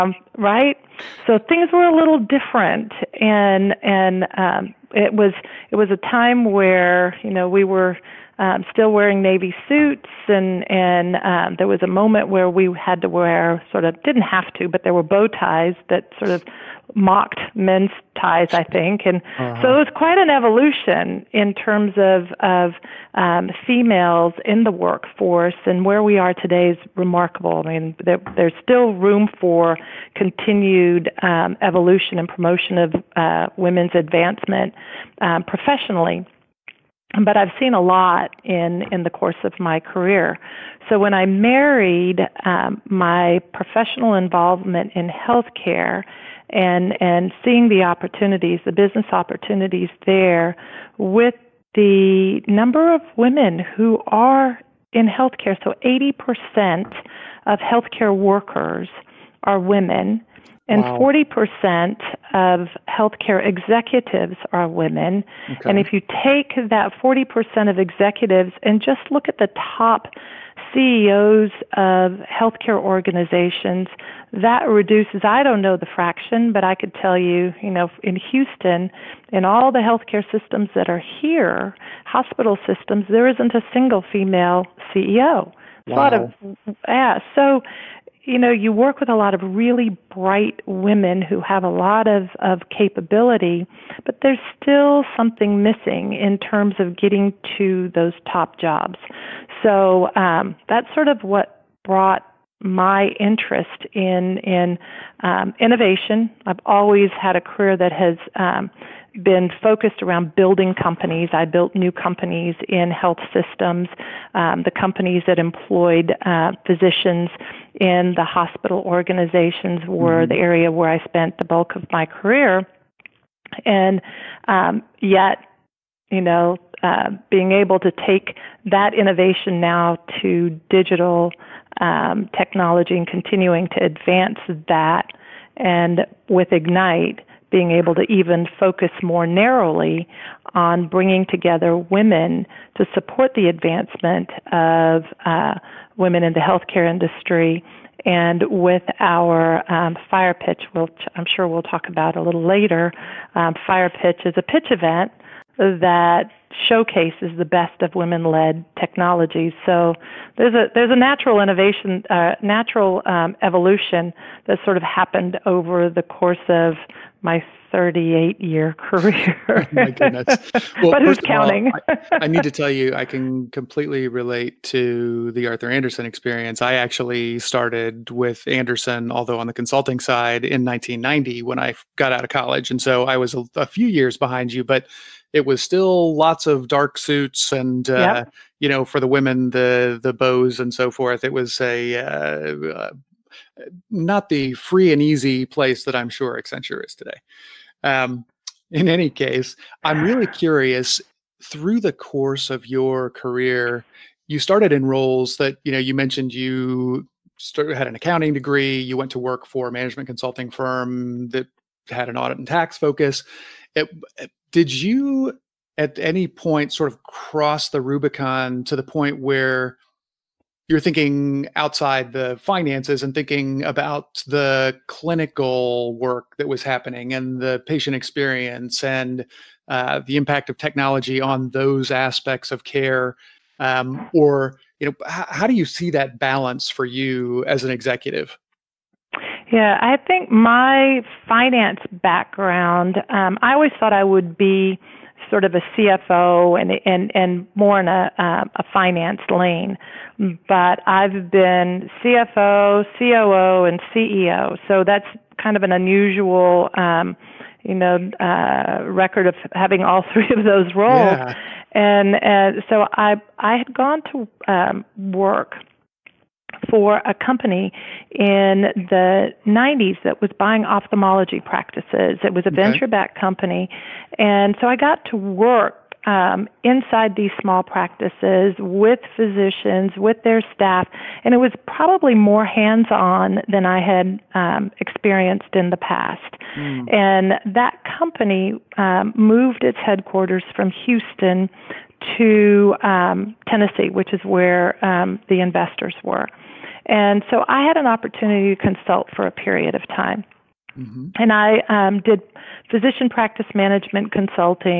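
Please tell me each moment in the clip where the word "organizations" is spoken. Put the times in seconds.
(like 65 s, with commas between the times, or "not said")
72 s, 118 s.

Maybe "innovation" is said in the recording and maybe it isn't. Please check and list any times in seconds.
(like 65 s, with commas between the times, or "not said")
105 s, 128 s, 161 s.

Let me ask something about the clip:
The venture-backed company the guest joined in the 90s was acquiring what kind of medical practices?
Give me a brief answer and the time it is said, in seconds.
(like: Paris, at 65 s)
Ophthalmology practices, at 270 s.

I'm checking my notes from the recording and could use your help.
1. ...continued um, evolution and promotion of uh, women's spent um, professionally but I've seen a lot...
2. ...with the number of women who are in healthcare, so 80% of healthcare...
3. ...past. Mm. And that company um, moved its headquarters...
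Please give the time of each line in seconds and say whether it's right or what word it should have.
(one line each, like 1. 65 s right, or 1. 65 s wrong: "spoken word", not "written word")
1. 30 s wrong: "advancement", not "spent"
2. 50 s right
3. 285 s right.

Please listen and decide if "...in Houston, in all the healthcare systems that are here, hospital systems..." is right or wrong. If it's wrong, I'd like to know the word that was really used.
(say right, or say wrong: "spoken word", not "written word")
right.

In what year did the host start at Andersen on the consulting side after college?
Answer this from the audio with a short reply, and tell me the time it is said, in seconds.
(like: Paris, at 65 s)
1990, at 180 s.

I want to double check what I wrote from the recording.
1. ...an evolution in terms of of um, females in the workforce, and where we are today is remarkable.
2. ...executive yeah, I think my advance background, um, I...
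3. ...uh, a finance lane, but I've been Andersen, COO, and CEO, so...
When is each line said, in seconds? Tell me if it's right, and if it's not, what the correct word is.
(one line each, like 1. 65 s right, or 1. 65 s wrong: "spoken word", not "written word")
1. 20 s right
2. 237 s wrong: "finance", not "advance"
3. 248 s wrong: "CFO", not "Andersen".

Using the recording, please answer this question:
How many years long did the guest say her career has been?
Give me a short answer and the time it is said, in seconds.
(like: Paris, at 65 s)
38, at 167 s.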